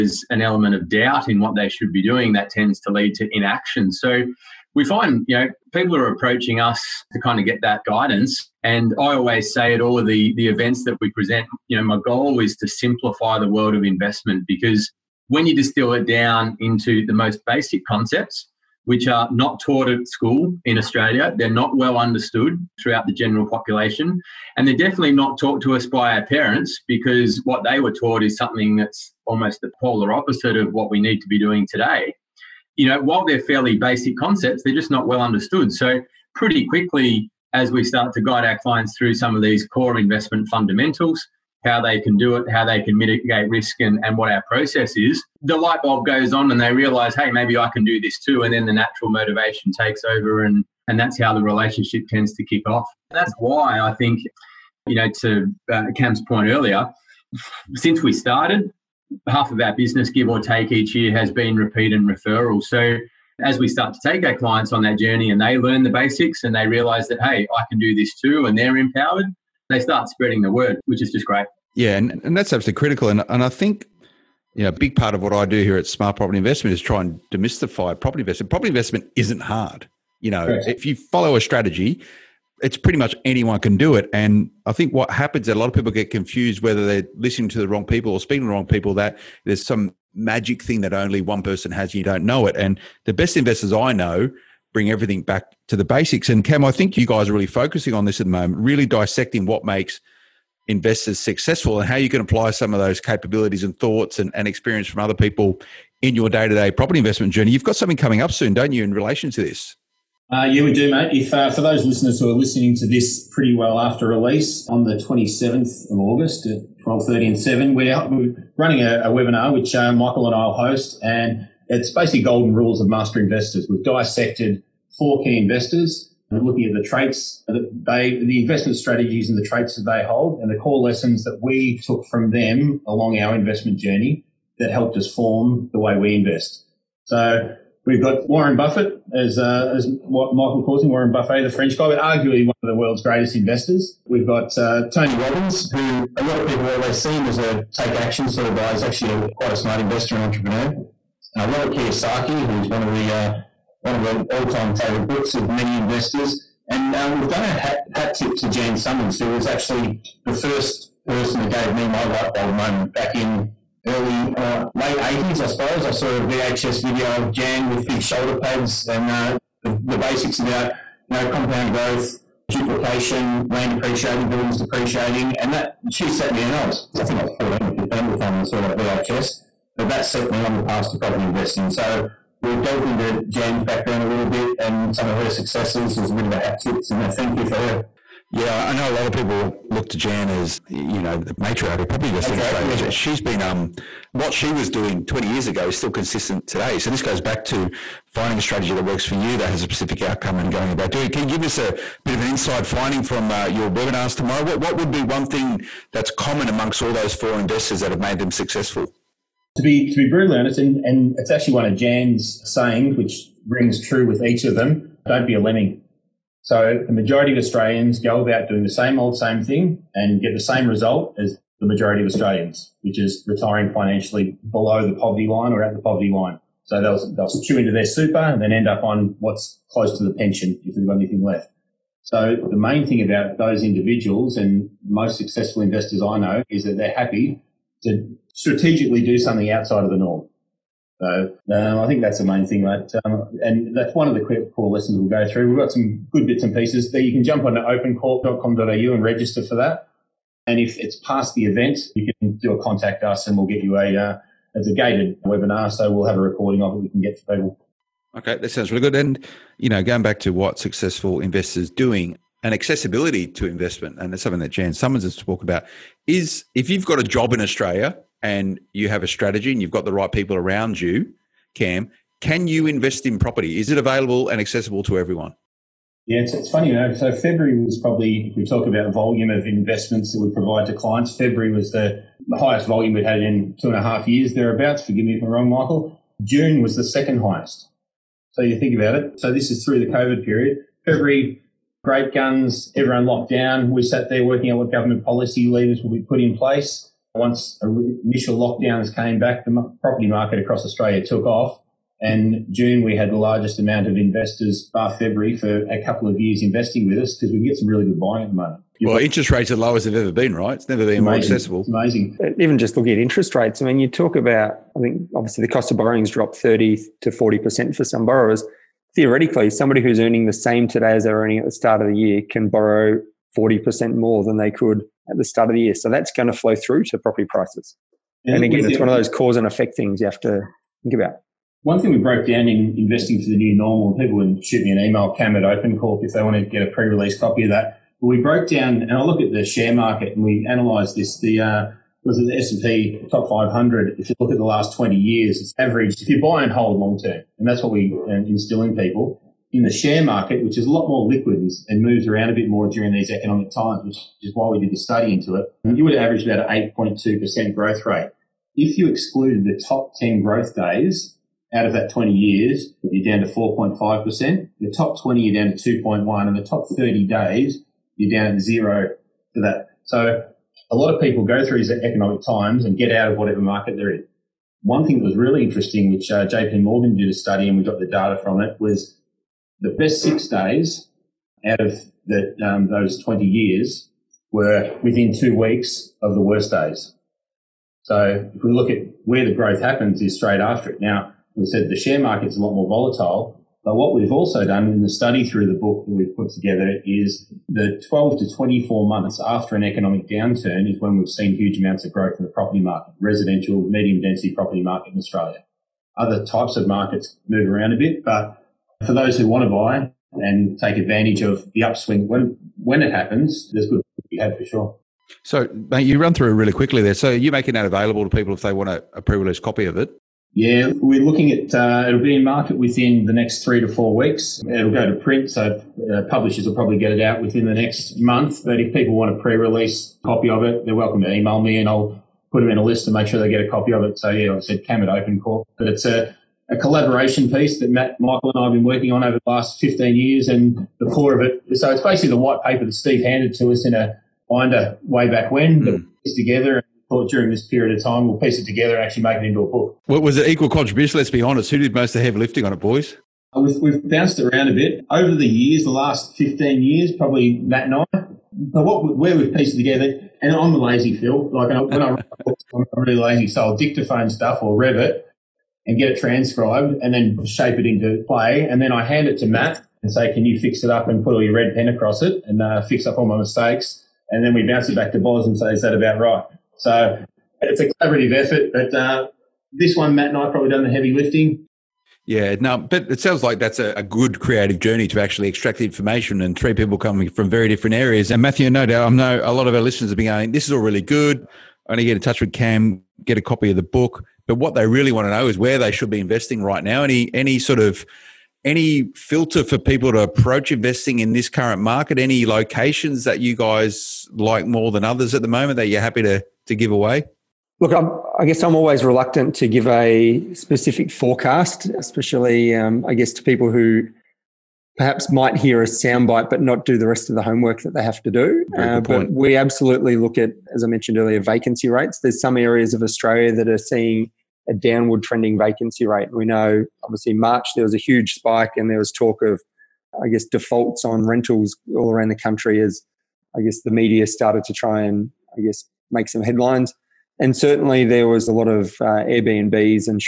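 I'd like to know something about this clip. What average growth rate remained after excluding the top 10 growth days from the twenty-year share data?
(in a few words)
4.5%.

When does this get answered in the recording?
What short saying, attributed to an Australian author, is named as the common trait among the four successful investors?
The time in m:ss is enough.
3:35.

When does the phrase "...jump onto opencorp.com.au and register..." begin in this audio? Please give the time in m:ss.
4:07.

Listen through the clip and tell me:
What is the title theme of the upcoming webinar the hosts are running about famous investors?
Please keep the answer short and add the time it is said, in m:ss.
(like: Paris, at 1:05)
golden rules of master investors, at 2:02.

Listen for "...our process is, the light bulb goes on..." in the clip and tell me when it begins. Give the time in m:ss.
0:44.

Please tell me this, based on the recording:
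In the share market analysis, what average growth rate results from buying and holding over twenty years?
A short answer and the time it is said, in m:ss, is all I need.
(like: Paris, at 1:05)
8.2%, at 5:56.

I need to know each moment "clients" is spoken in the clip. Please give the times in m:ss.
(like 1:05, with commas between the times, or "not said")
0:38, 1:04, 4:40.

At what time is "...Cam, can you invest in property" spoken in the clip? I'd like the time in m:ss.
4:31.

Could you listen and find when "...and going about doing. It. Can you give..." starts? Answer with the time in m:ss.
3:20.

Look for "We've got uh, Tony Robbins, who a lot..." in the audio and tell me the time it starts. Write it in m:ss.
2:24.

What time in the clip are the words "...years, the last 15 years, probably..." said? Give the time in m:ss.
7:35.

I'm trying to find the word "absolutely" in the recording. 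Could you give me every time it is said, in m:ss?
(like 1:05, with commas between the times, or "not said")
1:12, 8:39.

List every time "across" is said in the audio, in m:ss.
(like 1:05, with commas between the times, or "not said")
5:00, 7:51.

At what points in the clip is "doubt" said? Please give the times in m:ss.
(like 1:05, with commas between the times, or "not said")
0:00, 8:08.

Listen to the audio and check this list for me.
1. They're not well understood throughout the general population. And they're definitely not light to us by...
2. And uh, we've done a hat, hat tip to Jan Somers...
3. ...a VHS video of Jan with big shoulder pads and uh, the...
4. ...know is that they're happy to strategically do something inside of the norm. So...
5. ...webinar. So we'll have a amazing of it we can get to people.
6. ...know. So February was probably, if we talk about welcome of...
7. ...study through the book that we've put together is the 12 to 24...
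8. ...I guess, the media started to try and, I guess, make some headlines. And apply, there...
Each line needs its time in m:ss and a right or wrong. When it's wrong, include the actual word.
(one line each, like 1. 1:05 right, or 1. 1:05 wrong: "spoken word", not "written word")
1. 0:21 wrong: "taught", not "light"
2. 2:36 right
3. 2:46 right
4. 3:56 wrong: "outside", not "inside"
5. 4:15 wrong: "recording", not "amazing"
6. 4:36 wrong: "volume", not "welcome"
7. 6:34 right
8. 8:53 wrong: "certainly", not "apply".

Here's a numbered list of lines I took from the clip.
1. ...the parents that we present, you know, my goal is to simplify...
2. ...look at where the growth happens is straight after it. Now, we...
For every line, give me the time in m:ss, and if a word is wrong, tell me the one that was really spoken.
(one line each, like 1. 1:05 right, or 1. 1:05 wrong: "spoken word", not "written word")
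1. 0:10 wrong: "events", not "parents"
2. 6:28 right.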